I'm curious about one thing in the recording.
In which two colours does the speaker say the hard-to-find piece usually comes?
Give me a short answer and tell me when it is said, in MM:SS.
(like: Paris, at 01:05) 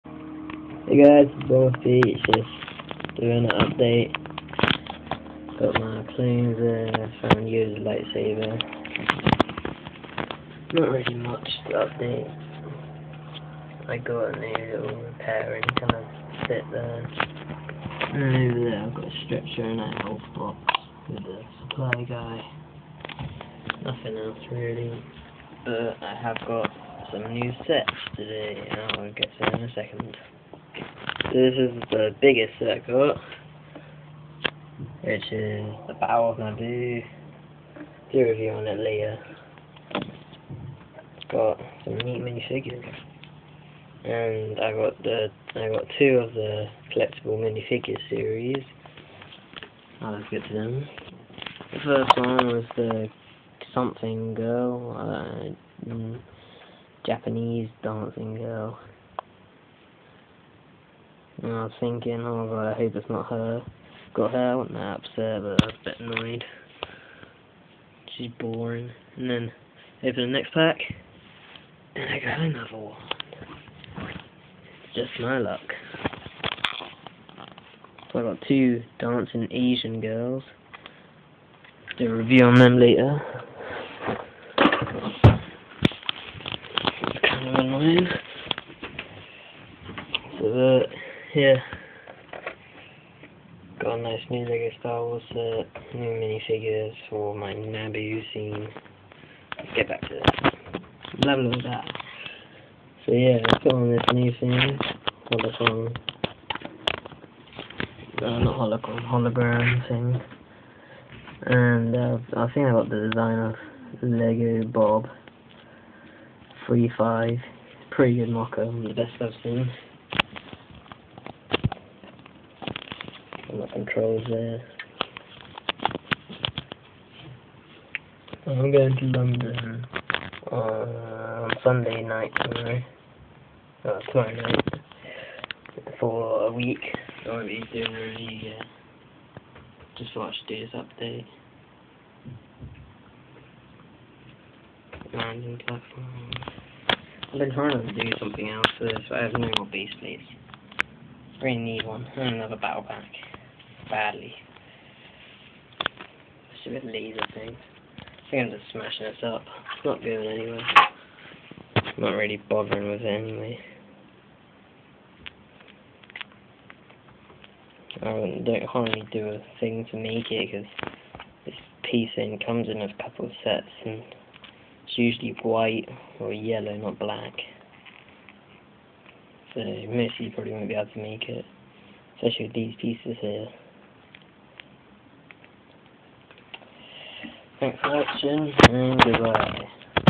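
White or yellow, at 02:55.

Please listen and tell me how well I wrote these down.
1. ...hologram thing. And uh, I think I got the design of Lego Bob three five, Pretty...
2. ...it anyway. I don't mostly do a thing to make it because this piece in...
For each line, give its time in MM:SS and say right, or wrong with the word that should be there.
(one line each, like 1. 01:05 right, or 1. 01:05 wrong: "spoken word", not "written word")
1. 01:49 right
2. 02:43 wrong: "hardly", not "mostly".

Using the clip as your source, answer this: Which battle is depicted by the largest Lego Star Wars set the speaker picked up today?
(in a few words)
Battle of Naboo.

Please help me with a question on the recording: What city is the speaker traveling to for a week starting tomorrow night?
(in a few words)
London.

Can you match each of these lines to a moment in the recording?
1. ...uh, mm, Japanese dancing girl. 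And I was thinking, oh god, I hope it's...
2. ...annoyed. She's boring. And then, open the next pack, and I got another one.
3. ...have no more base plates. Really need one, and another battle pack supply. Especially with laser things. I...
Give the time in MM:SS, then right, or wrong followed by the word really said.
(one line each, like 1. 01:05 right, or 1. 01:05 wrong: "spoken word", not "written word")
1. 00:54 right
2. 01:05 right
3. 02:29 wrong: "badly", not "supply".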